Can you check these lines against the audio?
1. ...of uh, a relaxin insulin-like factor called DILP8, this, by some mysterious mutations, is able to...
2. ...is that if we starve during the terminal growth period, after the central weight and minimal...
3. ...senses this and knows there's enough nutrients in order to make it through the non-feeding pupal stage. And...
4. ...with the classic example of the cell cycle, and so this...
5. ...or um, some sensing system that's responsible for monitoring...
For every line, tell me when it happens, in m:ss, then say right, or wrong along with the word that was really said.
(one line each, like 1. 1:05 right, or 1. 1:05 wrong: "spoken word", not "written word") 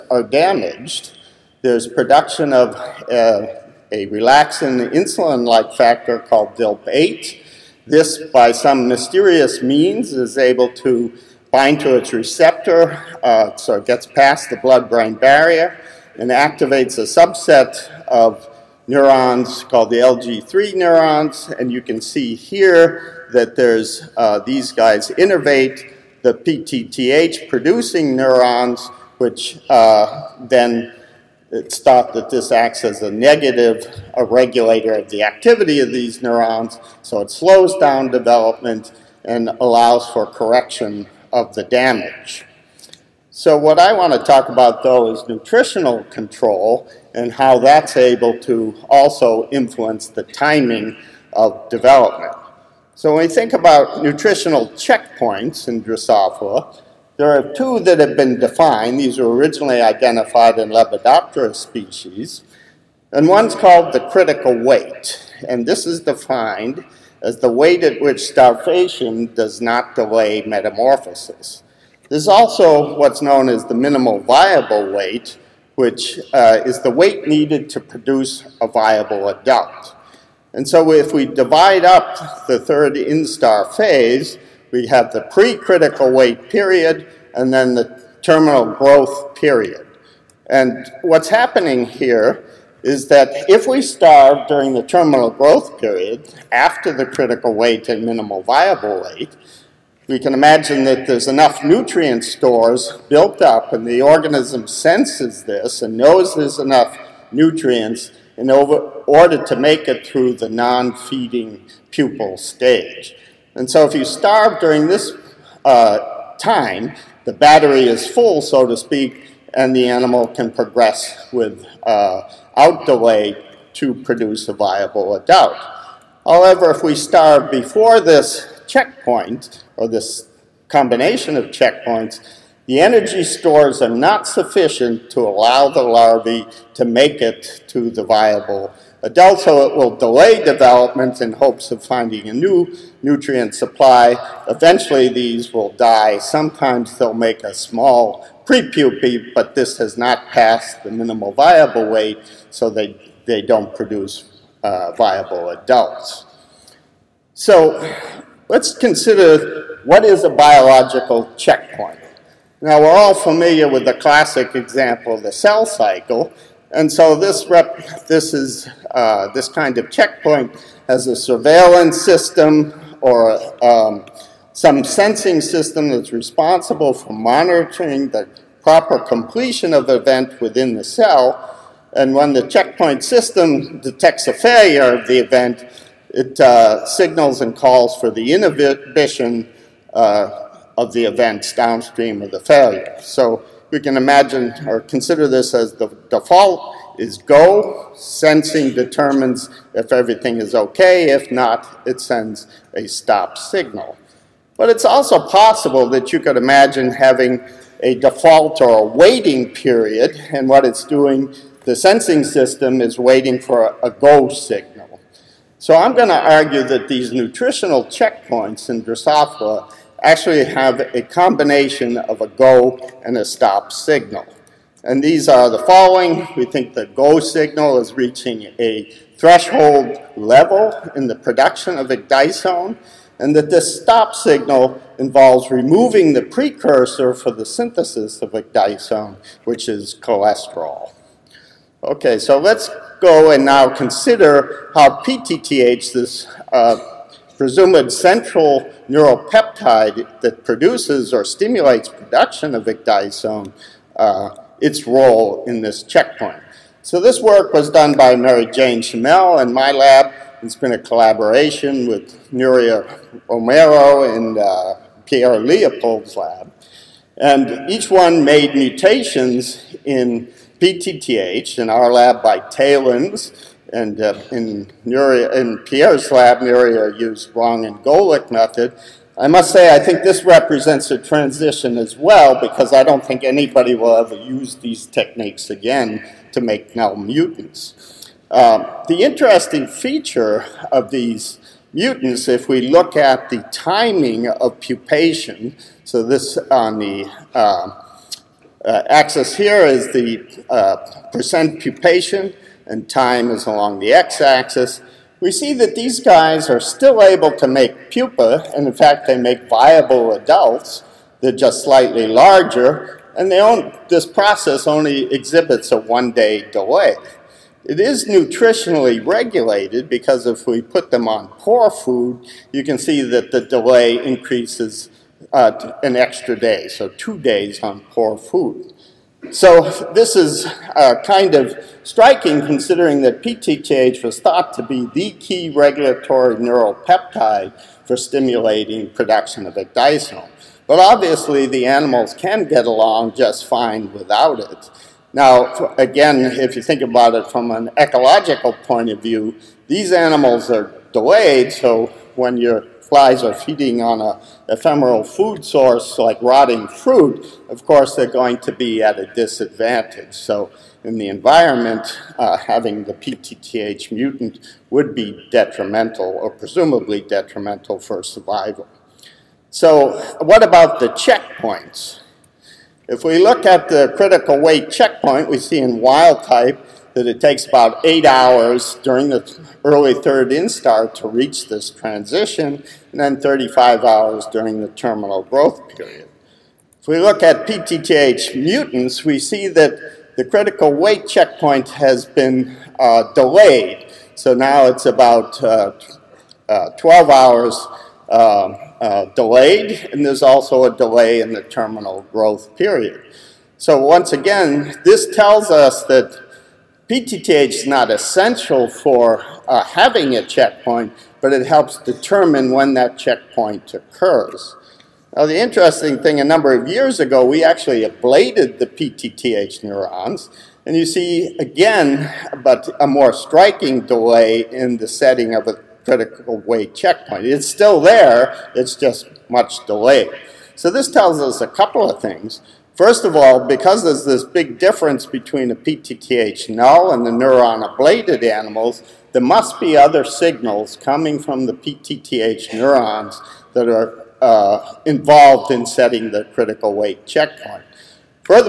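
1. 0:02 wrong: "means", not "mutations"
2. 1:32 wrong: "critical", not "central"
3. 1:44 right
4. 2:43 right
5. 2:53 right.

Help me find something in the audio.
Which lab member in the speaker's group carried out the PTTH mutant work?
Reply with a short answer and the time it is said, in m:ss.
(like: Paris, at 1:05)
Mary Jane Shimell, at 4:18.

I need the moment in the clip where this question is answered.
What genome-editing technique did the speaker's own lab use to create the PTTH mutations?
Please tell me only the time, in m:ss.
4:32.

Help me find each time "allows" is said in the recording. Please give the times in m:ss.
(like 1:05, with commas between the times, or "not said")
0:39, 2:15.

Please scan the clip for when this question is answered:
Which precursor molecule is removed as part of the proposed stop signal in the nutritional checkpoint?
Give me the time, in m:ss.
4:00.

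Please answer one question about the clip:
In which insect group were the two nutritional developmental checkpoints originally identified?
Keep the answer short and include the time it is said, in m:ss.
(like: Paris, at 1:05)
Lepidoptera, at 1:00.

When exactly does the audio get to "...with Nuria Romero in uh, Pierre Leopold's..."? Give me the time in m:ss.
4:21.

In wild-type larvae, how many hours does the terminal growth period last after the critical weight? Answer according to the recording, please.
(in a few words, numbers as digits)
35 hours.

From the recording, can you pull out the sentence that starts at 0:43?
So what I want to talk about, though, is nutritional control and how that's able to also influence the timing of development.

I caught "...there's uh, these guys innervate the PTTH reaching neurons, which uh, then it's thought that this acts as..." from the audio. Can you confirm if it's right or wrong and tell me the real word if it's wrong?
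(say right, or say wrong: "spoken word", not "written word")
wrong: "producing", not "reaching".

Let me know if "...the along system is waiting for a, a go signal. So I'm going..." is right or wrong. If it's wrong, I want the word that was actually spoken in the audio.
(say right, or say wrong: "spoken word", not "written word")
wrong: "sensing", not "along".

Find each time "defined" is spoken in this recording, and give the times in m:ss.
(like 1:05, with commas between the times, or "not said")
0:58, 1:05.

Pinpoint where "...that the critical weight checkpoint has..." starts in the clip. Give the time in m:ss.
6:29.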